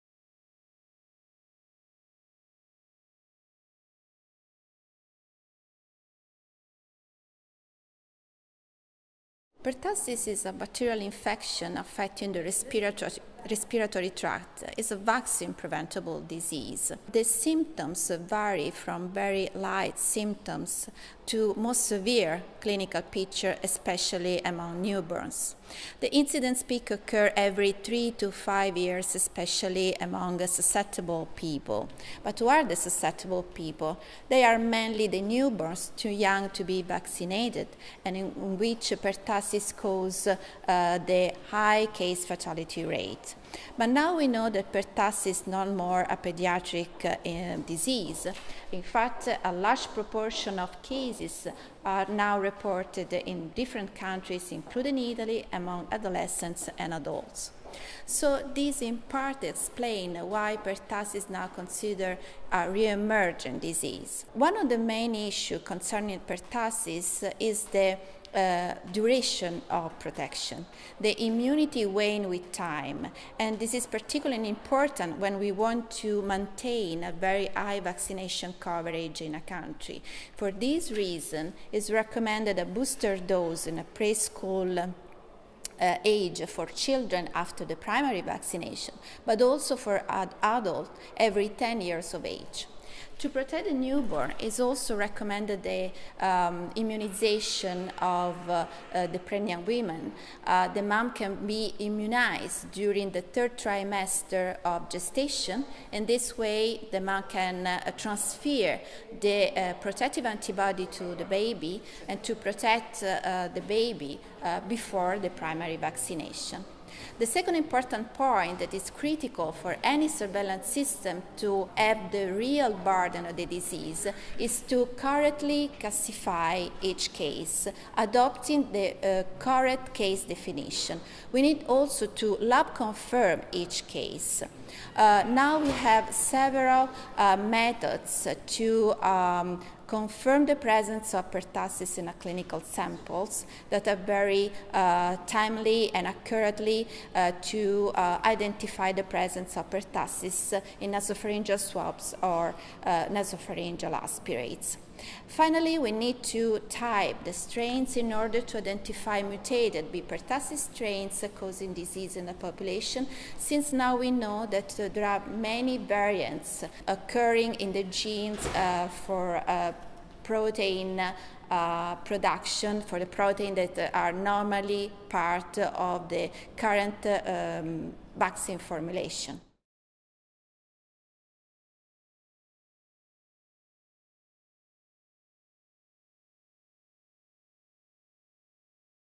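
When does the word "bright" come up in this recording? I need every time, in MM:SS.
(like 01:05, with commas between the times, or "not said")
not said.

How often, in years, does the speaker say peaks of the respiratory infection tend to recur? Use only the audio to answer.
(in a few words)
3 to 5 years.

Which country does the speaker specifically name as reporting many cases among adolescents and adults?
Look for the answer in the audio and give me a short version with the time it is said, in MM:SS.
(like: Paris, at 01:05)
Italy, at 00:54.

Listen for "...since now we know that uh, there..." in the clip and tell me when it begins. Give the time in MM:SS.
02:43.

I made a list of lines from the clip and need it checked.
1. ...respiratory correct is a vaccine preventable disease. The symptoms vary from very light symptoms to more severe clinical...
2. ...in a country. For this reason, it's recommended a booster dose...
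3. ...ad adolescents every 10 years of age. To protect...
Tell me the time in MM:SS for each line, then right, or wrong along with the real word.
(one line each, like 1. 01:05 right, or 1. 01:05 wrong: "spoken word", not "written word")
1. 00:13 wrong: "tract", not "correct"
2. 01:19 right
3. 01:30 wrong: "adults", not "adolescents".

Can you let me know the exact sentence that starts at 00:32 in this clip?
But who are the susceptible people?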